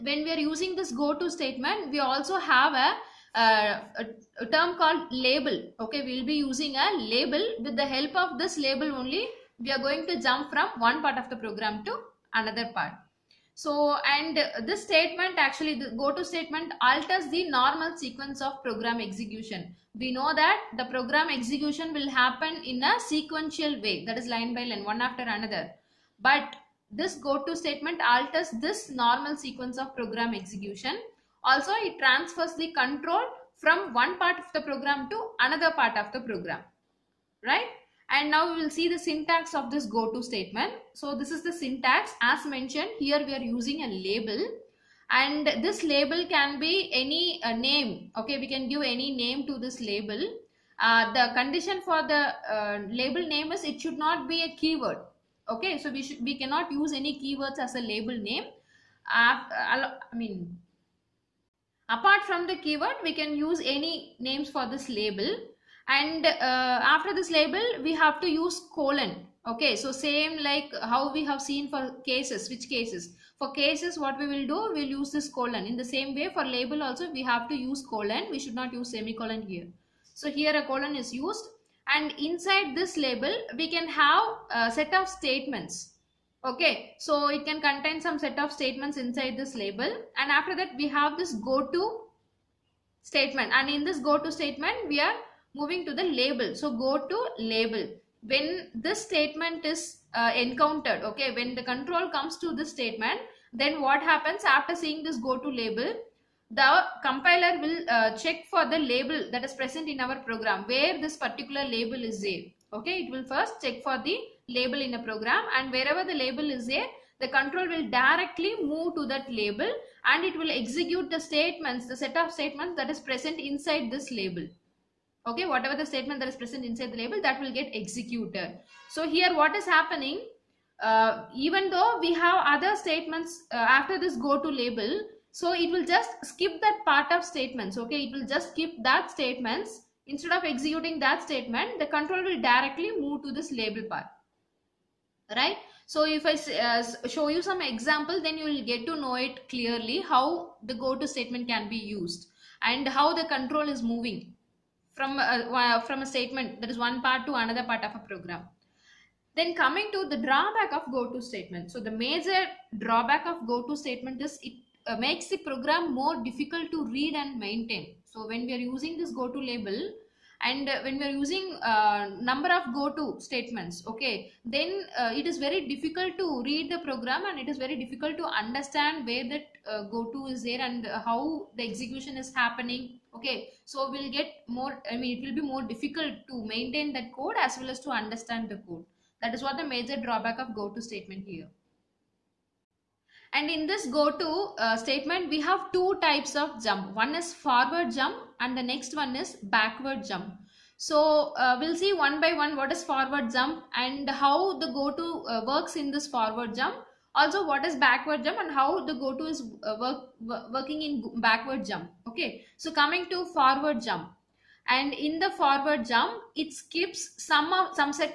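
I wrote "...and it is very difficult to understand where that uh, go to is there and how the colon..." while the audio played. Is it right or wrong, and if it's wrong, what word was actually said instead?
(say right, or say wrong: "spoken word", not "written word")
wrong: "execution", not "colon".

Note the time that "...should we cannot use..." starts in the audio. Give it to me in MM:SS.
00:56.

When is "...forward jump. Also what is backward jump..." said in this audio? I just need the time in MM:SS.
03:26.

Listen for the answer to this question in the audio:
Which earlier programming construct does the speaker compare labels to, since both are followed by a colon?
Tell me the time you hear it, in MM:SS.
01:12.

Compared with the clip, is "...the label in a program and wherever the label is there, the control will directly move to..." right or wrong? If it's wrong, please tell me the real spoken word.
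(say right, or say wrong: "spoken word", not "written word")
right.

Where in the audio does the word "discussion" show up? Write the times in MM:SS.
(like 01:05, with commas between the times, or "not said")
not said.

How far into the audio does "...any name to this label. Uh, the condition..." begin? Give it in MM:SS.
00:48.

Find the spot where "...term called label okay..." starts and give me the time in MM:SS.
00:04.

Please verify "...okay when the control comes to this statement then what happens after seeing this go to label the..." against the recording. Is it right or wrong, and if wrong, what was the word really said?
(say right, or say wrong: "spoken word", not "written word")
right.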